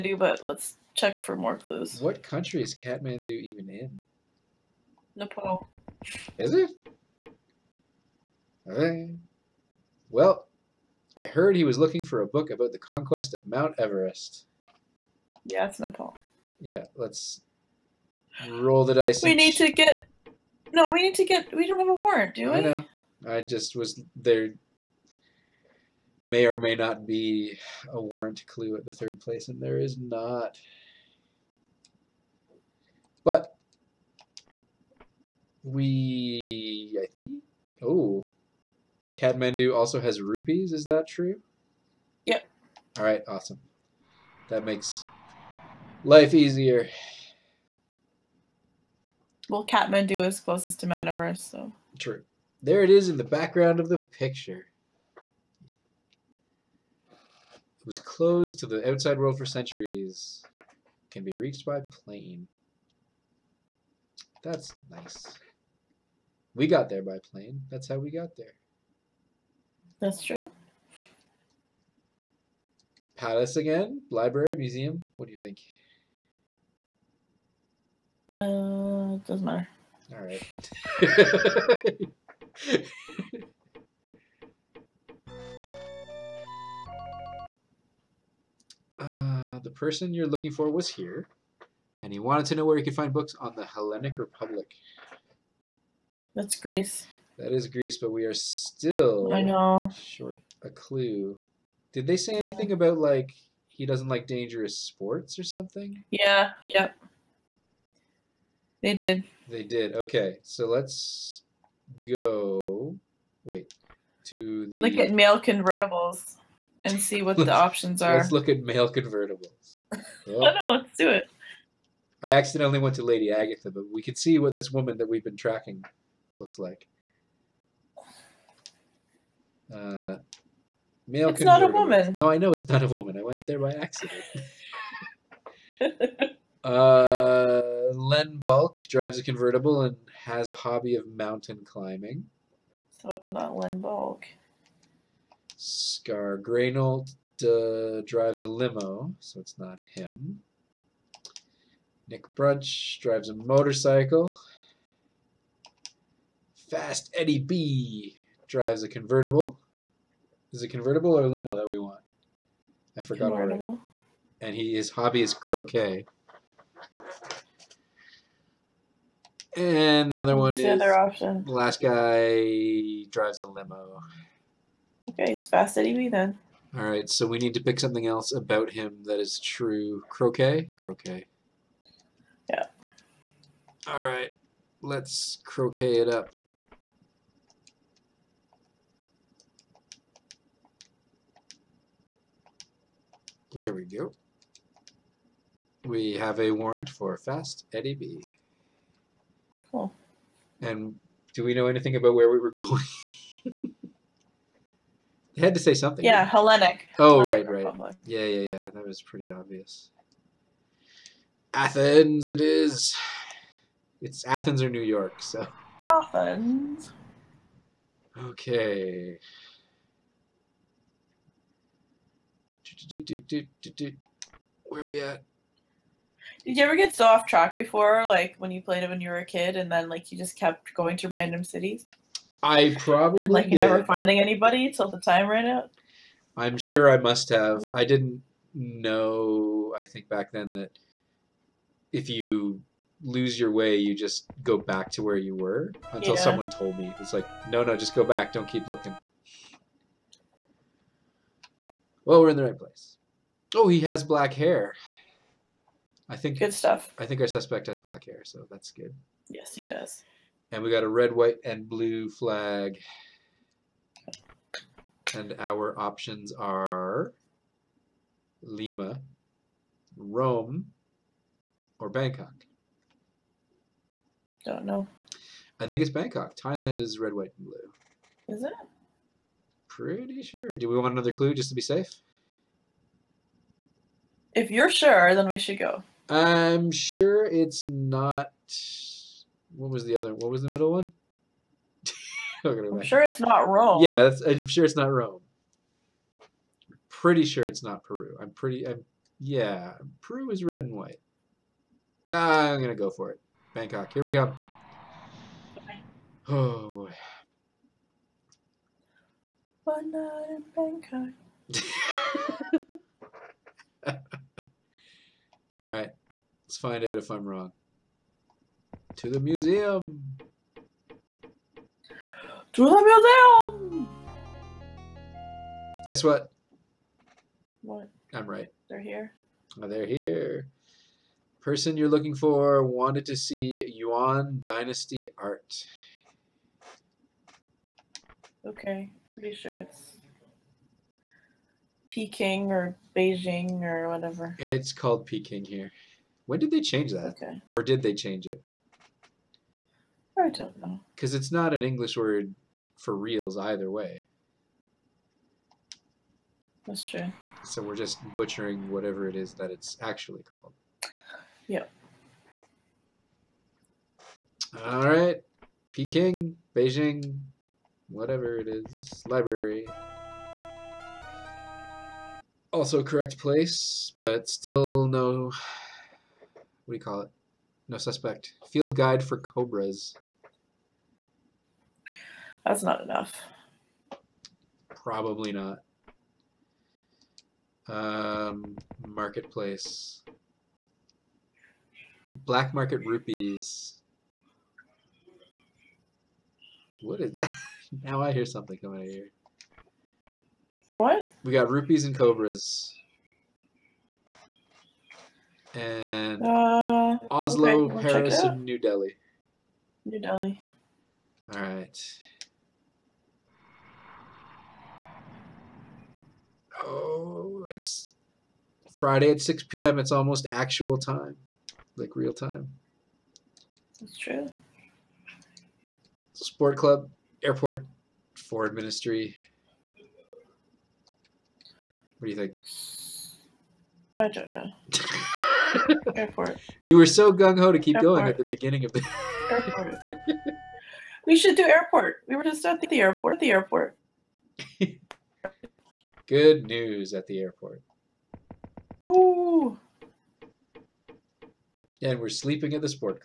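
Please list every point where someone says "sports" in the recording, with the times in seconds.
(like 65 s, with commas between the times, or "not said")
104 s, 426 s.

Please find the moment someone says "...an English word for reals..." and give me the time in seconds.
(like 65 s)
351 s.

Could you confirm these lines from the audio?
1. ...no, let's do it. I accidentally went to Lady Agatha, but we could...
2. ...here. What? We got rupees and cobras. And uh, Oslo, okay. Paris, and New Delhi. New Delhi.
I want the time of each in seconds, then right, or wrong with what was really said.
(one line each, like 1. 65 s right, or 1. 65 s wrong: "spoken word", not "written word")
1. 120 s right
2. 398 s right.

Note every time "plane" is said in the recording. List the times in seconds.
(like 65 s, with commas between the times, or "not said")
61 s, 67 s.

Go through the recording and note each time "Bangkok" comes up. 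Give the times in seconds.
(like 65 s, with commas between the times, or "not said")
271 s, 275 s, 303 s, 310 s.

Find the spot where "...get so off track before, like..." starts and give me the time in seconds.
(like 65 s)
226 s.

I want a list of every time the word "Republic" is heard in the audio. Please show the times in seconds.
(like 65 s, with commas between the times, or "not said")
94 s, 207 s.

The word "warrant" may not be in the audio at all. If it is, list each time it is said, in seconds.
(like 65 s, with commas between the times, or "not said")
21 s, 28 s, 196 s.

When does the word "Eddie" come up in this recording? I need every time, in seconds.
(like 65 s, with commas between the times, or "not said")
157 s, 175 s, 197 s.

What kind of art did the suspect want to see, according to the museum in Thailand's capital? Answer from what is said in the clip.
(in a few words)
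Yuan Dynasty art.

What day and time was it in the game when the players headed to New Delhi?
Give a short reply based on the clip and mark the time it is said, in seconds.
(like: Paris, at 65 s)
Friday at 6 p.m., at 418 s.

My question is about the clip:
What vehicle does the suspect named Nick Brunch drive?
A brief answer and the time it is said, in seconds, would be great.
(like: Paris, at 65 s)
Motorcycle, at 153 s.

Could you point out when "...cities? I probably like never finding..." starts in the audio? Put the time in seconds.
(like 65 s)
231 s.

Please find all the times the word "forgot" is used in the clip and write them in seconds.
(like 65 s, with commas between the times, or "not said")
163 s.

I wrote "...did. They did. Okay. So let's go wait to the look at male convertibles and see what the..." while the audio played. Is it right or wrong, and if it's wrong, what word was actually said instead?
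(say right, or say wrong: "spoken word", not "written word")
right.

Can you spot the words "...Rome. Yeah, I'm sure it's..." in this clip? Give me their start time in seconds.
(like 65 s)
293 s.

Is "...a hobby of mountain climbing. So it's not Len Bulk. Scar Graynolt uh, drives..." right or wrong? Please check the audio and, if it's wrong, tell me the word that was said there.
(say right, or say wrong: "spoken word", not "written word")
right.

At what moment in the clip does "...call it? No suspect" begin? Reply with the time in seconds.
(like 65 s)
376 s.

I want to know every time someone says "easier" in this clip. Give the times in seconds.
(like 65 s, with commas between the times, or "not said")
46 s.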